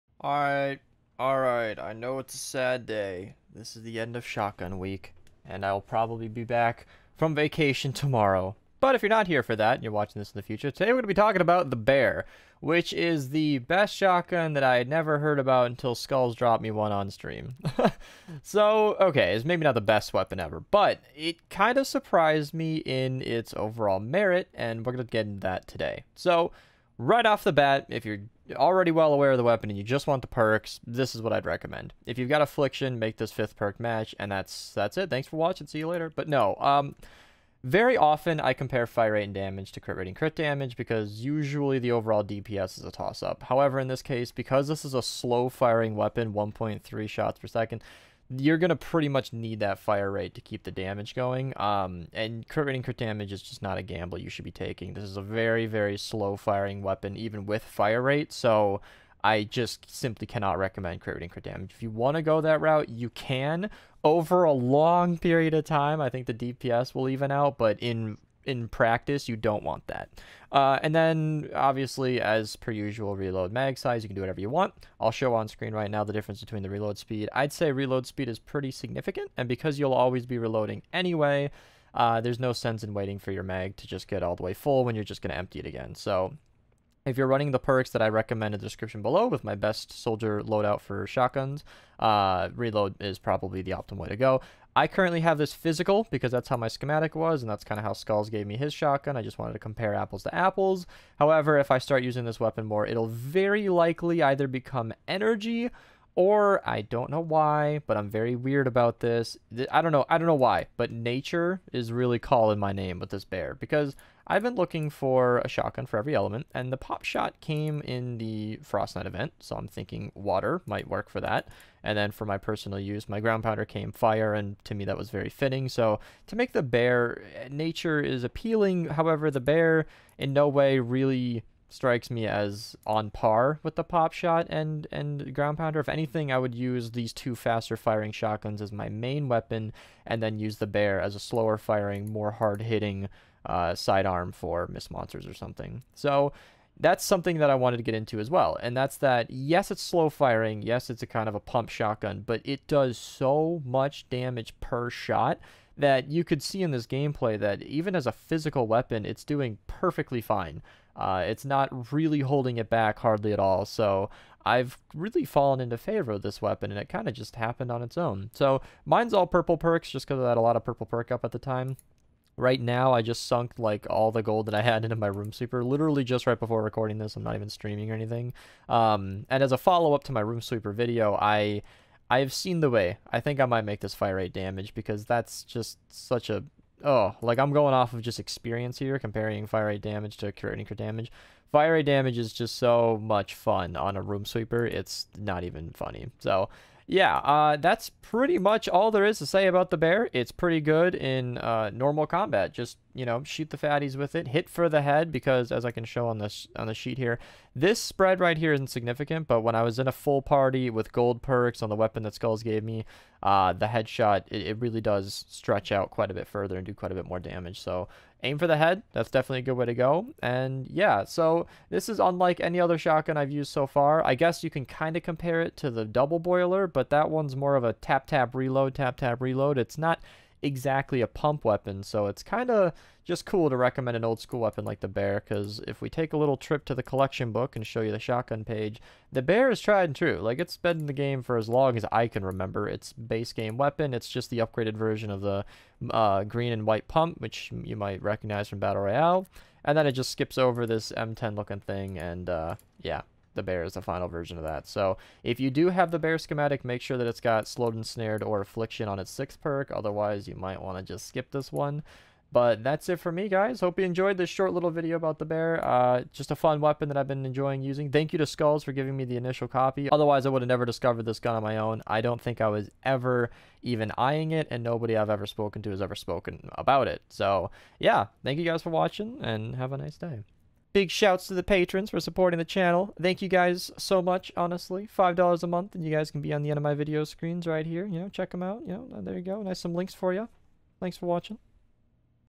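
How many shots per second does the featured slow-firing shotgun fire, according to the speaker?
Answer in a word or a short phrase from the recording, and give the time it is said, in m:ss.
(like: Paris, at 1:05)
1.3, at 0:46.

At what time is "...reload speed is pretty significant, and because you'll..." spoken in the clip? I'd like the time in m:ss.
1:17.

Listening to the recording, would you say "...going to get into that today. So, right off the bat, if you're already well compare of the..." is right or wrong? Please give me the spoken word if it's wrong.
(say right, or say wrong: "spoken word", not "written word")
wrong: "aware", not "compare".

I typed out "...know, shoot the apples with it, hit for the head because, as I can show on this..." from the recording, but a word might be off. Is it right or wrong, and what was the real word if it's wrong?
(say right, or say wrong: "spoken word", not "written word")
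wrong: "fatties", not "apples".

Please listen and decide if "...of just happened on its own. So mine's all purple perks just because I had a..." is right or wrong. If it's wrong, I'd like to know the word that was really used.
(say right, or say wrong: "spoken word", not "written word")
right.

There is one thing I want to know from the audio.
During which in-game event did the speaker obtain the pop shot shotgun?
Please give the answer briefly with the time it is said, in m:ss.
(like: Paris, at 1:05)
Frostnite, at 1:58.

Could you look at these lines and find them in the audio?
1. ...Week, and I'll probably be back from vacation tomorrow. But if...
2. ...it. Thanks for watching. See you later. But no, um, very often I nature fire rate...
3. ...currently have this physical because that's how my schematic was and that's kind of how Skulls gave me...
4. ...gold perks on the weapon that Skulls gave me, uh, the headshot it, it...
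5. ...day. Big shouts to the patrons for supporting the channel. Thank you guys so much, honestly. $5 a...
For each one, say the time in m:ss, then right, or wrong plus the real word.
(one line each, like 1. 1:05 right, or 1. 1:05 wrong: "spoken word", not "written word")
1. 0:04 right
2. 0:34 wrong: "compare", not "nature"
3. 1:34 right
4. 3:30 right
5. 4:39 right.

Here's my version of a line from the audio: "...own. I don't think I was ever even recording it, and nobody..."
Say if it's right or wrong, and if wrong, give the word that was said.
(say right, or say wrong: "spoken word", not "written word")
wrong: "eyeing", not "recording".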